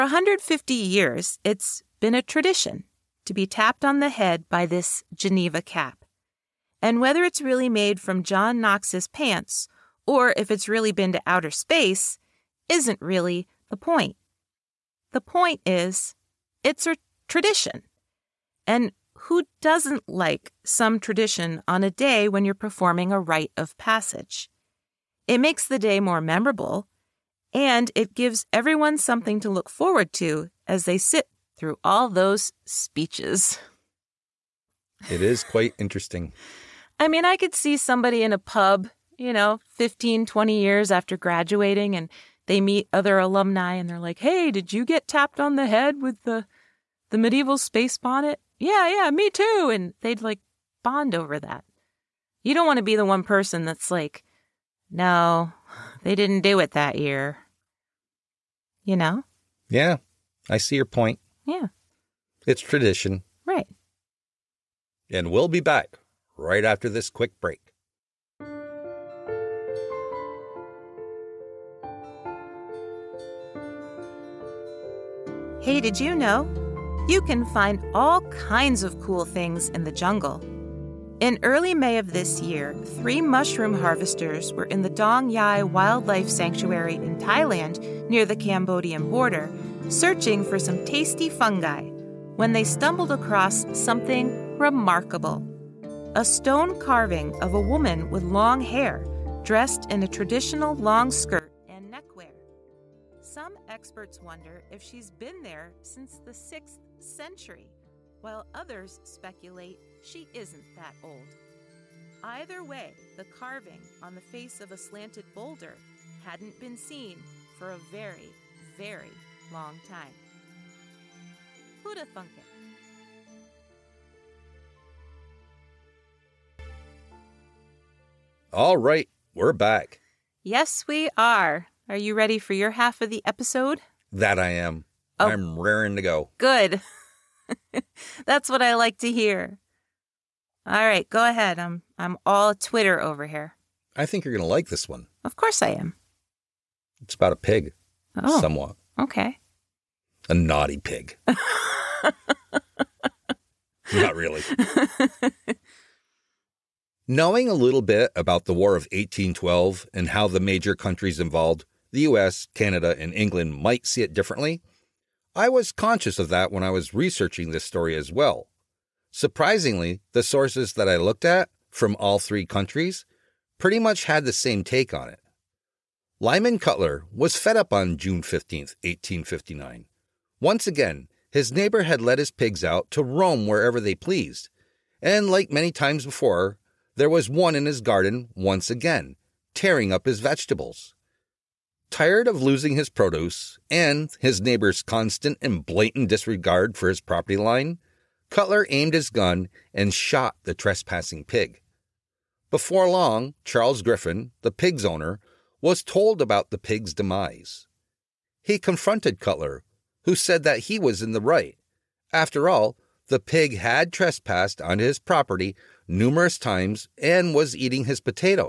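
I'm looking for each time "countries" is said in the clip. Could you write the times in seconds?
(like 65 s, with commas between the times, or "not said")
160 s, 172 s.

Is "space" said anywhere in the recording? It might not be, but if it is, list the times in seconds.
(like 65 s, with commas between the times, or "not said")
11 s, 47 s.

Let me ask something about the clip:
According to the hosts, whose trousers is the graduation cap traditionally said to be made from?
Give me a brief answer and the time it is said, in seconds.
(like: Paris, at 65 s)
John Knox, at 8 s.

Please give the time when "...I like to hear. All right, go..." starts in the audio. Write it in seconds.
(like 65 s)
138 s.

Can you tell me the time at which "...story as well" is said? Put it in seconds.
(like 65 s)
167 s.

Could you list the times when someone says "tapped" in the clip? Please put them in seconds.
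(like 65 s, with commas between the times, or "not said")
3 s, 45 s.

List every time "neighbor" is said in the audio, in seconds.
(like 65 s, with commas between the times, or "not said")
181 s, 194 s.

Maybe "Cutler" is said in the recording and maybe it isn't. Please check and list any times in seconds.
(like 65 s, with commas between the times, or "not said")
176 s, 198 s, 209 s.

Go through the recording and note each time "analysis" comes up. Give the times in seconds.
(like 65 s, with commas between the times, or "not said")
not said.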